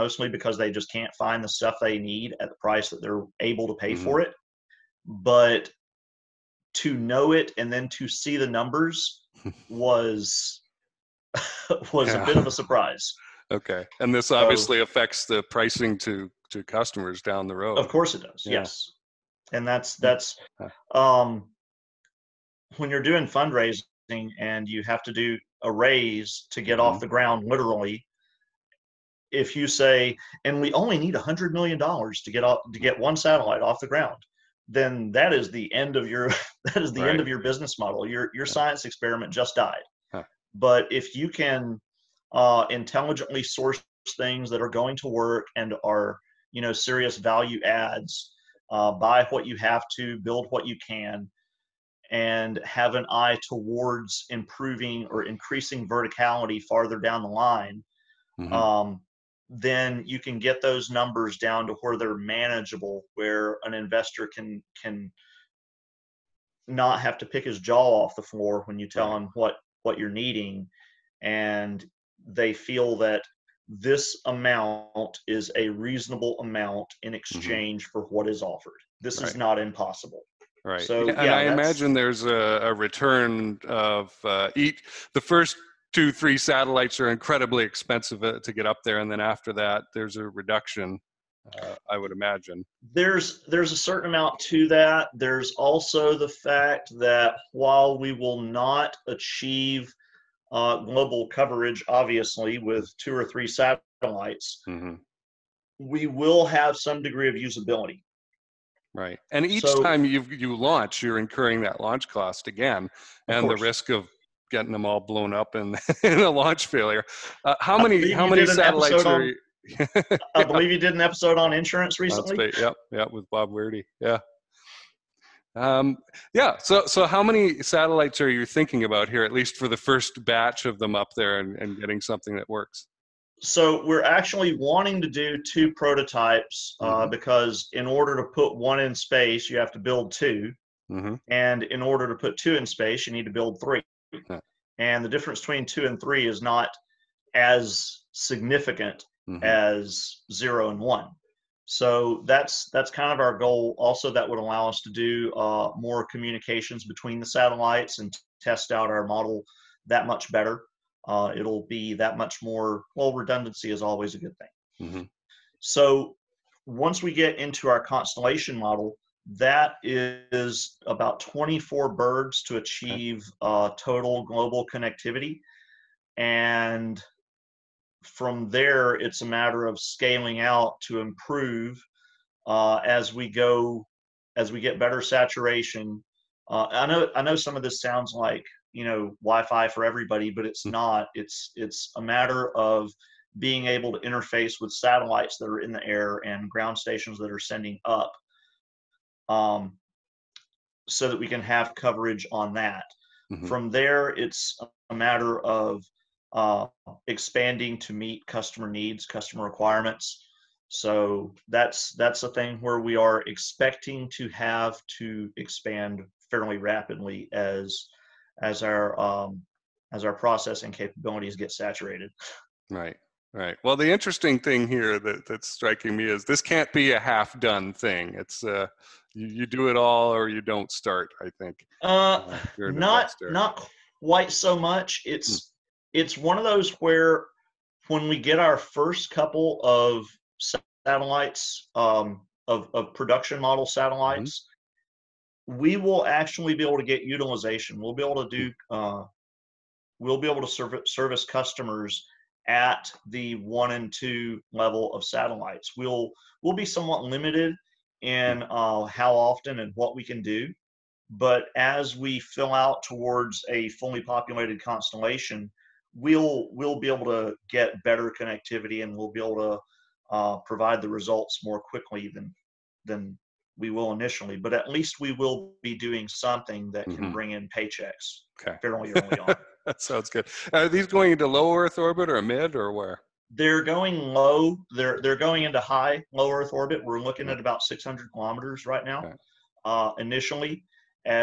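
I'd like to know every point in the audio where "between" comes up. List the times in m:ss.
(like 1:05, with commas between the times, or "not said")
2:25, 2:36.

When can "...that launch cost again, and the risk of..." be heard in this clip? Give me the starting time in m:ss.
1:51.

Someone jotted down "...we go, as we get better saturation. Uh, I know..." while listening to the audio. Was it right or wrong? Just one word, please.
right.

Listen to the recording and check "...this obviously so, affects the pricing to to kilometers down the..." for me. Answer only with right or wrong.
wrong.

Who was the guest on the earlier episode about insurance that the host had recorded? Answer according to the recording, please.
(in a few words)
Bob Weirdy.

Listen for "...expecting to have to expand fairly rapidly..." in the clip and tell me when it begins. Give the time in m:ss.
3:33.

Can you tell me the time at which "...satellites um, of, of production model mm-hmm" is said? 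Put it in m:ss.
4:00.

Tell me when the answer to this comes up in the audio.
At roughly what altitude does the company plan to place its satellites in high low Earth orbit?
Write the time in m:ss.
4:47.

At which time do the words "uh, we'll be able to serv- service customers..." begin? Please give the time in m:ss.
4:08.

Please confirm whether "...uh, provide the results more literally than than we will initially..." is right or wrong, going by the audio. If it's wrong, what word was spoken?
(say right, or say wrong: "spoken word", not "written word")
wrong: "quickly", not "literally".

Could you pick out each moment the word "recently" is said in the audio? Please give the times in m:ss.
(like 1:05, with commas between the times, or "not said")
2:01.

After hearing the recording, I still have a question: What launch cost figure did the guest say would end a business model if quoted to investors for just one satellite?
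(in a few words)
$100 million.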